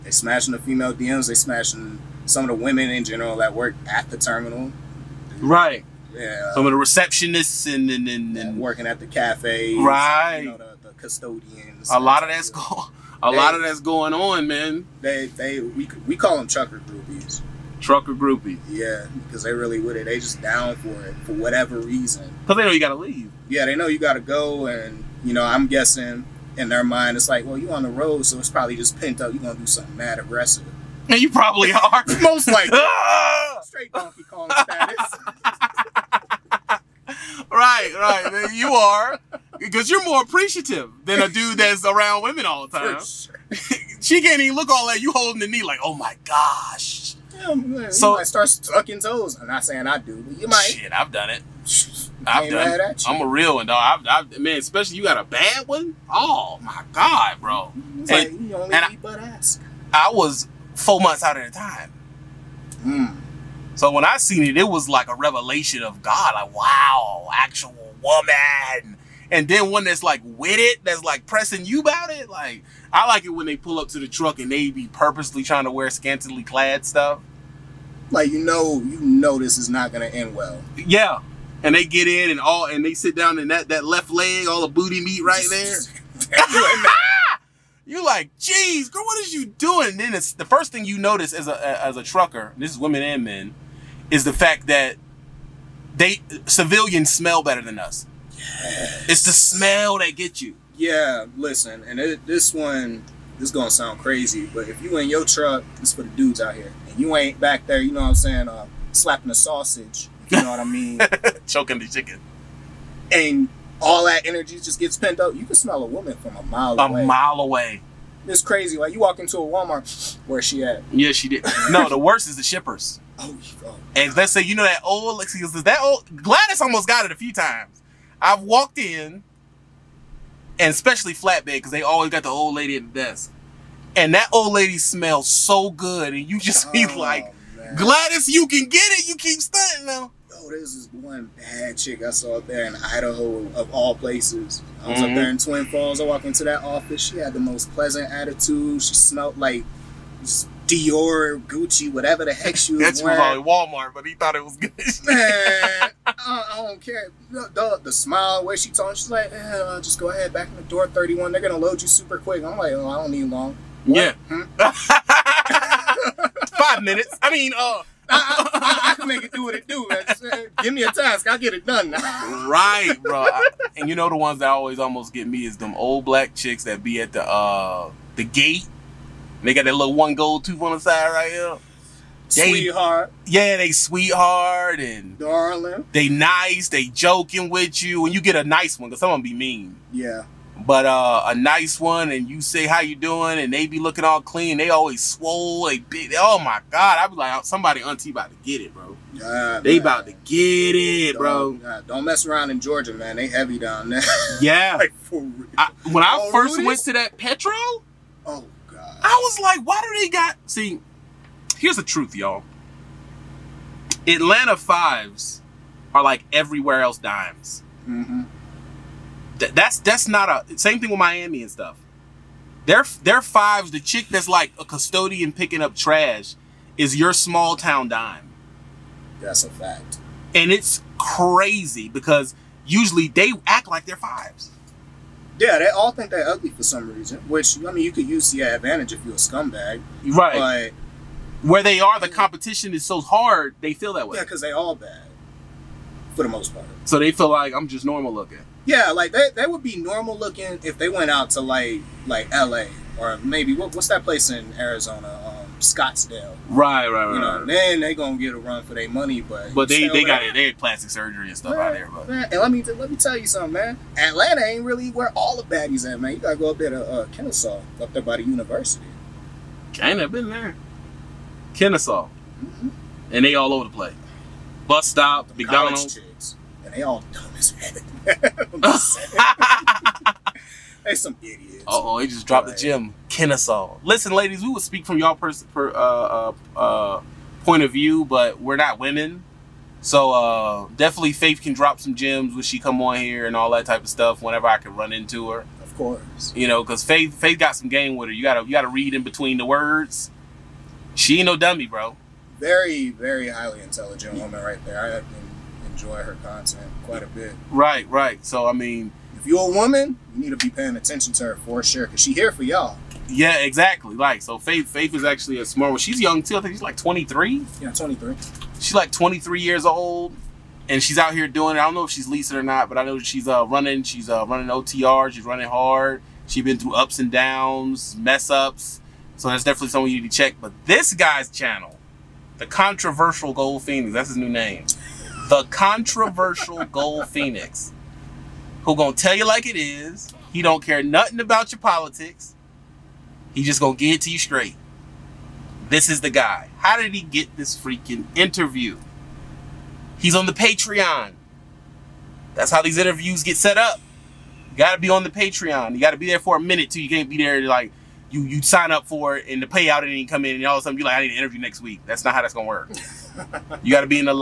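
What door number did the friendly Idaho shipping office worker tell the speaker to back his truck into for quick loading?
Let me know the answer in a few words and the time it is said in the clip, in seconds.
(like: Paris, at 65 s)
31, at 160 s.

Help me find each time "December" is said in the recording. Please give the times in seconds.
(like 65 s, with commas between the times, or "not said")
not said.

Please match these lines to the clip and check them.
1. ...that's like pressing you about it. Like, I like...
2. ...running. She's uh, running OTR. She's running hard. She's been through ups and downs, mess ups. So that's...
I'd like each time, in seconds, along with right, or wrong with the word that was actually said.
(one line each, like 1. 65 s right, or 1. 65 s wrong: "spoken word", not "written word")
1. 70 s right
2. 323 s right.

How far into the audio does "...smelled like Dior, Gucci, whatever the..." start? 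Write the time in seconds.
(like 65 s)
148 s.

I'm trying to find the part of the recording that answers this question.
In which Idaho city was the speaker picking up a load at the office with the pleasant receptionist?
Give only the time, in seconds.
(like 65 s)
145 s.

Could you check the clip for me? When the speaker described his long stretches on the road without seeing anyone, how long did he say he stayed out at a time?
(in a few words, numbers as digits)
4 months.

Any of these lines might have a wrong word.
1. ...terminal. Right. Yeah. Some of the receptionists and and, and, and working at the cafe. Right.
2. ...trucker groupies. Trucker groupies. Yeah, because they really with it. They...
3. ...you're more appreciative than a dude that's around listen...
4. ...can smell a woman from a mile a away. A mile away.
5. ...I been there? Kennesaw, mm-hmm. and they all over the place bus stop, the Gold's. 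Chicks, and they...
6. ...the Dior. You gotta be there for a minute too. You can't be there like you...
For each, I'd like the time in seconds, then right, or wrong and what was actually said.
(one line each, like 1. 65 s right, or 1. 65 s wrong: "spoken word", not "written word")
1. 4 s right
2. 16 s right
3. 39 s wrong: "women", not "listen"
4. 115 s right
5. 270 s wrong: "McDonald", not "Gold"
6. 355 s wrong: "Patreon", not "Dior".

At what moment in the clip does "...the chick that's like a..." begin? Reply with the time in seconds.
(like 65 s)
223 s.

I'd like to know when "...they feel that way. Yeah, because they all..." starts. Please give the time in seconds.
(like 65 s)
243 s.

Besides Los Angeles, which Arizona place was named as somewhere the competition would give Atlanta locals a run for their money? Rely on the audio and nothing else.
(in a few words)
Scottsdale.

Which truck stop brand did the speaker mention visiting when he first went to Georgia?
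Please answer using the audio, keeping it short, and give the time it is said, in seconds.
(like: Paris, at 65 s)
Petro, at 207 s.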